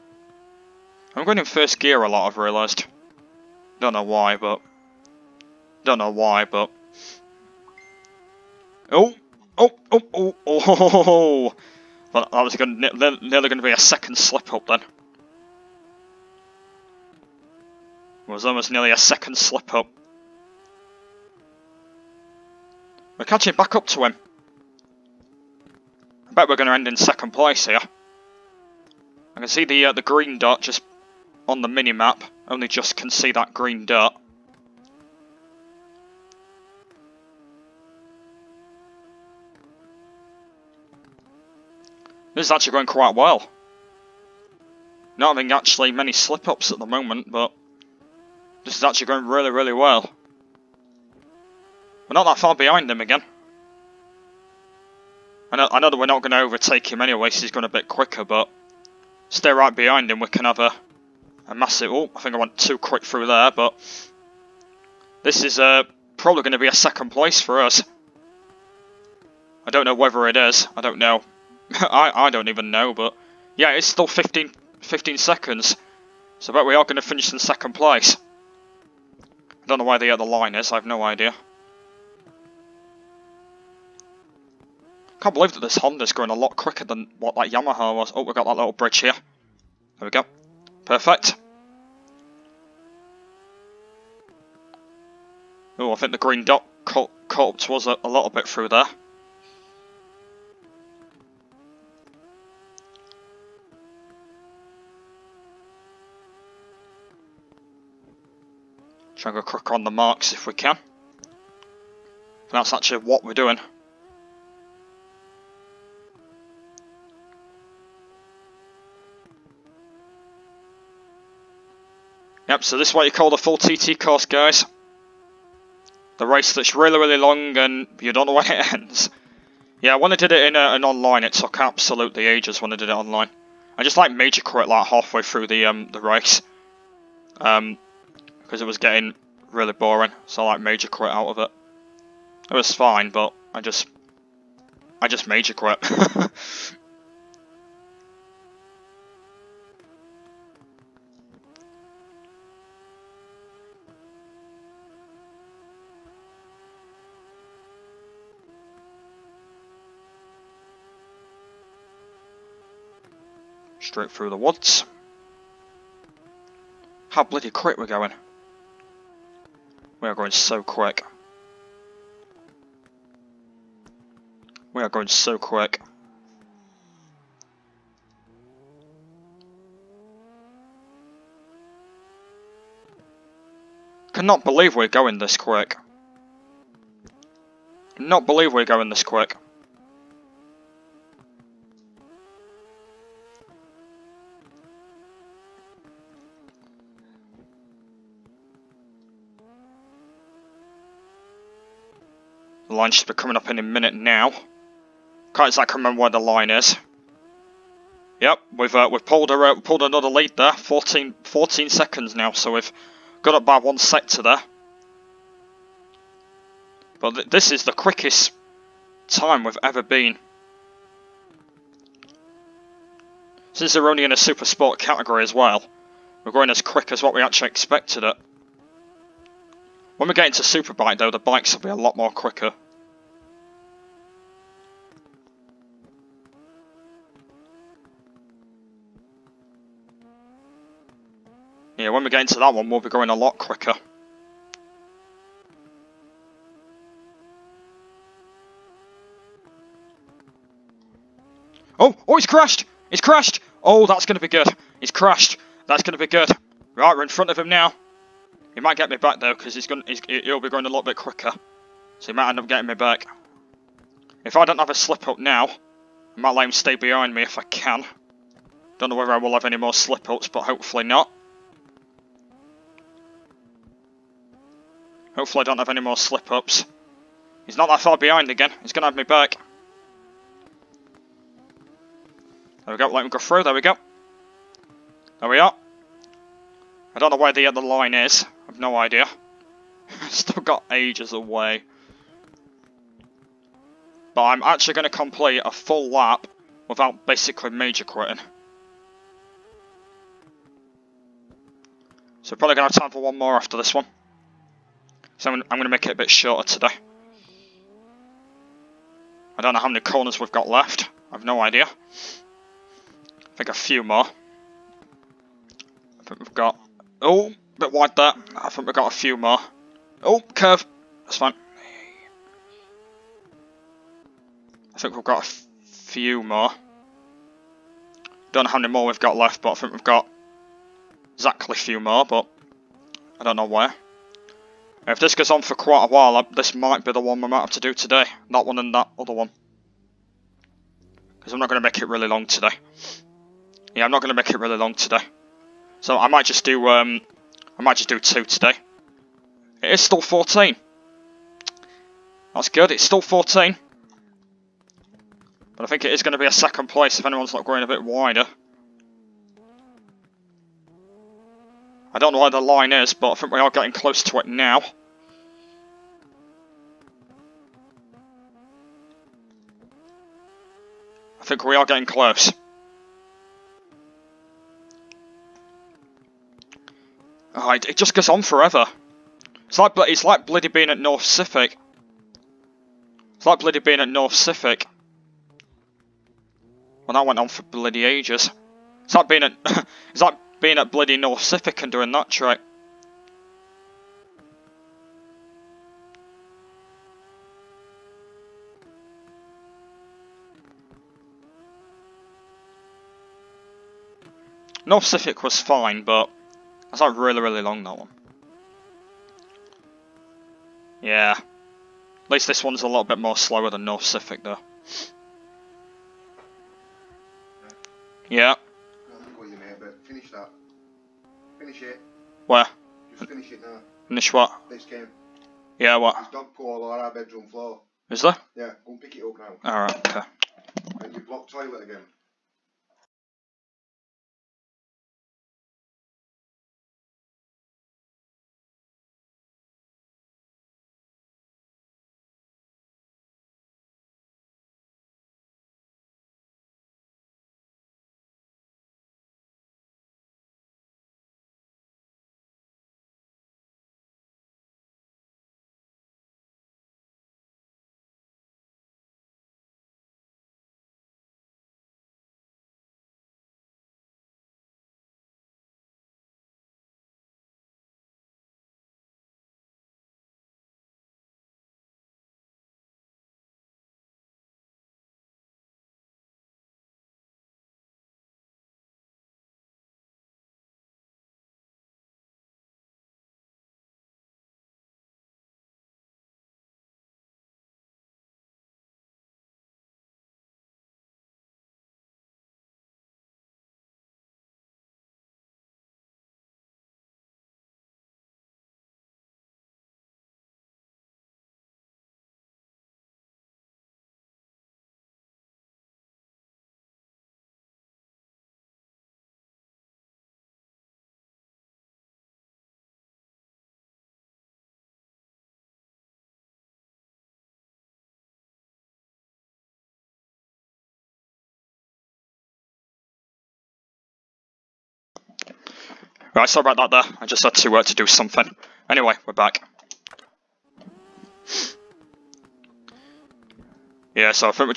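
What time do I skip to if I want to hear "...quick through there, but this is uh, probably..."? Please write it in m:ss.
1:02.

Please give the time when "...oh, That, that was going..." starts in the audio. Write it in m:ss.
0:11.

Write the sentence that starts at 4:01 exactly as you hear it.
Yeah, when we get into that one, we'll be going a lot quicker.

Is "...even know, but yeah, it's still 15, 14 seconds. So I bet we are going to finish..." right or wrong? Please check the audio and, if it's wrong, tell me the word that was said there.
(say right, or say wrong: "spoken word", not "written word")
wrong: "15", not "14".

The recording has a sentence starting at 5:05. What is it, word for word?
So I'm, I'm going to make it a bit shorter today.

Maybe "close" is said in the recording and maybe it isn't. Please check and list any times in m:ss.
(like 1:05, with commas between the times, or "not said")
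6:03, 6:11.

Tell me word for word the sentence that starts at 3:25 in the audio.
Can't exactly remember where the line is.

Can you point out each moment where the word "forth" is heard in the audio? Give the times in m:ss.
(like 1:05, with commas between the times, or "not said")
not said.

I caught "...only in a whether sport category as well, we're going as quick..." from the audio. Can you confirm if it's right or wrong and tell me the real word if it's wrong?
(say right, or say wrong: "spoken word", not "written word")
wrong: "super", not "whether".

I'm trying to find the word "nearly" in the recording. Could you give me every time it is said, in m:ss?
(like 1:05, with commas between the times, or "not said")
0:12, 0:18.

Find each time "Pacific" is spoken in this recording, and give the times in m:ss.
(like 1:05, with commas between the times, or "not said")
6:44, 6:53.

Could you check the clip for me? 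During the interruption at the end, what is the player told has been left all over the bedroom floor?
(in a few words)
dog poo.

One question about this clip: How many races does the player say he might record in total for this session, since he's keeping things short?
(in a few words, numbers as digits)
2.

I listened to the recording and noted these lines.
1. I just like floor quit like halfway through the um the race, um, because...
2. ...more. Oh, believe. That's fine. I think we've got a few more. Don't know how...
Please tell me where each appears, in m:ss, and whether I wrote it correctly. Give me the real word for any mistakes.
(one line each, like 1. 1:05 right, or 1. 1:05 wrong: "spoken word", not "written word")
1. 2:13 wrong: "major", not "floor"
2. 5:19 wrong: "curve", not "believe".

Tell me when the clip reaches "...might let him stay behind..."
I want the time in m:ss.
4:26.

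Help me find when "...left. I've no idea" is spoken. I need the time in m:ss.
5:10.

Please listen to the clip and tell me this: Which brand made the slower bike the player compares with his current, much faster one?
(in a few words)
Yamaha.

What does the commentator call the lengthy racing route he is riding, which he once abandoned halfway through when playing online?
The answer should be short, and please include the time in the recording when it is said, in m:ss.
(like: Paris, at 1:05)
full TT course, at 2:03.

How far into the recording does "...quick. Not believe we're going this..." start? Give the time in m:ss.
3:05.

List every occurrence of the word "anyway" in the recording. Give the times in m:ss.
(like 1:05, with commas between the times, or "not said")
0:57, 8:48.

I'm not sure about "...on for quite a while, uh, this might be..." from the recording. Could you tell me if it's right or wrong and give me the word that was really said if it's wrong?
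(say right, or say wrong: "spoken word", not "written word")
right.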